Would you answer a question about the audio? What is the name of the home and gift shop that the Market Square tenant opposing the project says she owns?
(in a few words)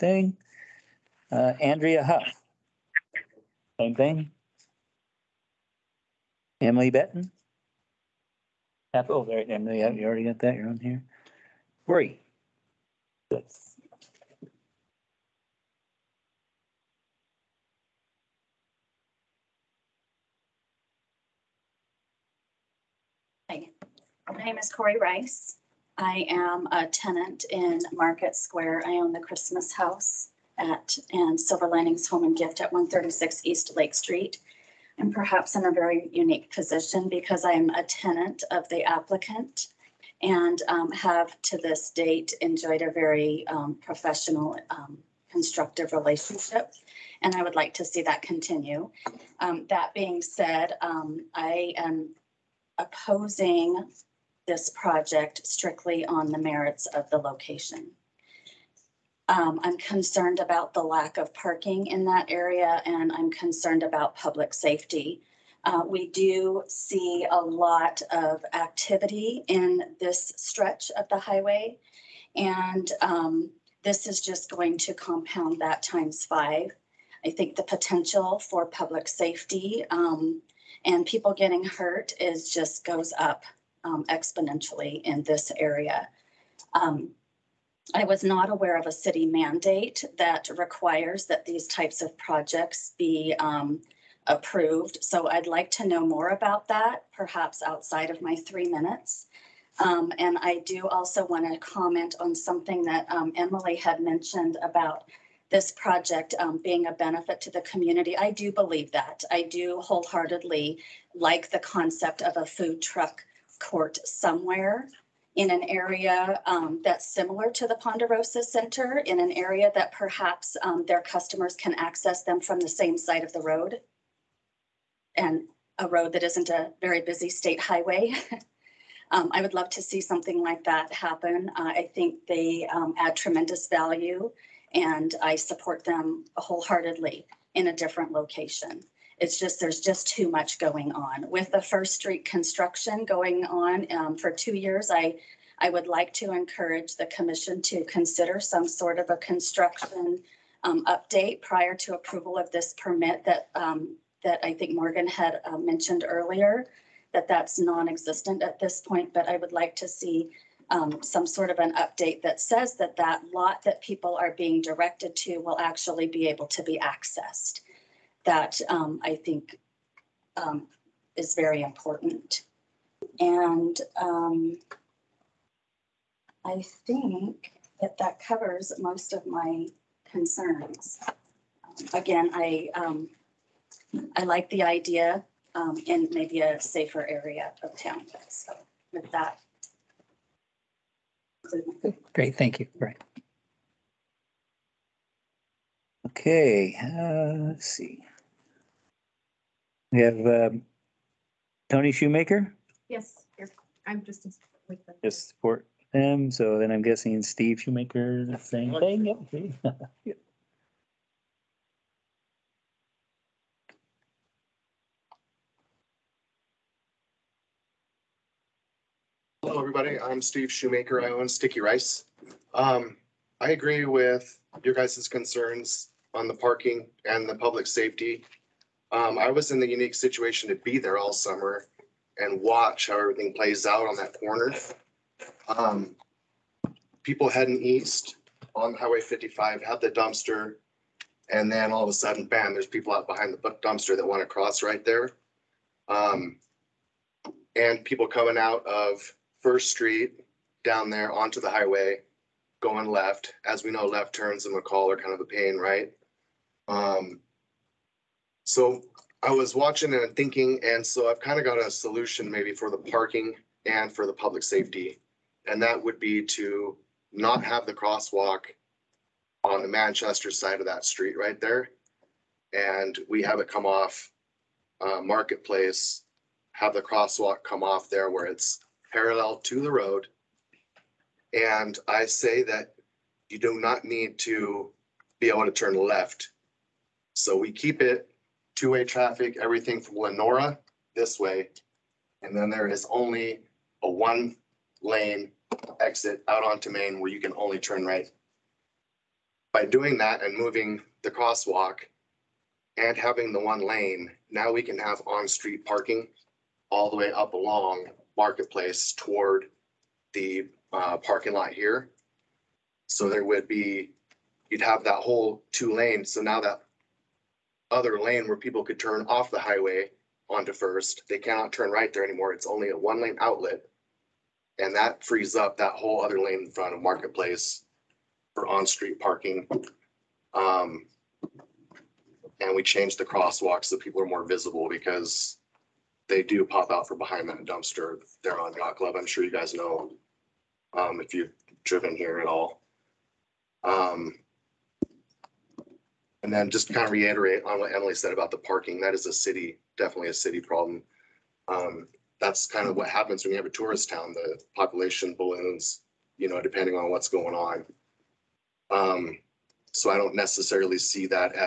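Silver Linings Home and Gift.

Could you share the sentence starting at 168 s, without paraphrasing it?
That um, I think um, is very important.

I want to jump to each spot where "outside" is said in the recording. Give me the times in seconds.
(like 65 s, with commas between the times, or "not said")
97 s.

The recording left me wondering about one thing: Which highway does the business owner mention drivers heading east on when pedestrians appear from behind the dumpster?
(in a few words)
Highway 55.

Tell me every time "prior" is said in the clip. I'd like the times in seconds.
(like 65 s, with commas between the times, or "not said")
151 s.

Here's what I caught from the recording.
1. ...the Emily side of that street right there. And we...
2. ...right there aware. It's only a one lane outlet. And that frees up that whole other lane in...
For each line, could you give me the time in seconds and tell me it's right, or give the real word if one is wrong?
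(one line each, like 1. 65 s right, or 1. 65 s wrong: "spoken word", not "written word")
1. 269 s wrong: "Manchester", not "Emily"
2. 321 s wrong: "anymore", not "aware".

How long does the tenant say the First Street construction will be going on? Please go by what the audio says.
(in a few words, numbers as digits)
2 years.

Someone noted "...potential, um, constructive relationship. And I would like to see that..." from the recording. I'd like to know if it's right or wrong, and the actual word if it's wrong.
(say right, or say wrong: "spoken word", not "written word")
wrong: "professional", not "potential".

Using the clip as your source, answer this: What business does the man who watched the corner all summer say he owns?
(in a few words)
Sticky Rice.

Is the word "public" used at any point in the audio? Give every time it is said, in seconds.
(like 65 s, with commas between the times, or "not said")
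64 s, 78 s, 227 s, 264 s.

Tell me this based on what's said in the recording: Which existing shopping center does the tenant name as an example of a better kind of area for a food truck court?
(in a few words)
Ponderosa Center.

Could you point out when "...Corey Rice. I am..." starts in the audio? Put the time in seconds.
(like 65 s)
24 s.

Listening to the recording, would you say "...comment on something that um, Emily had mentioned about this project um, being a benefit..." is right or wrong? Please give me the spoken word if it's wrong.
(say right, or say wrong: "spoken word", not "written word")
right.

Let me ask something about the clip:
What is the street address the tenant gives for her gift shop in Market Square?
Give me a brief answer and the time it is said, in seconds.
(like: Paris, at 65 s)
136 East Lake Street, at 32 s.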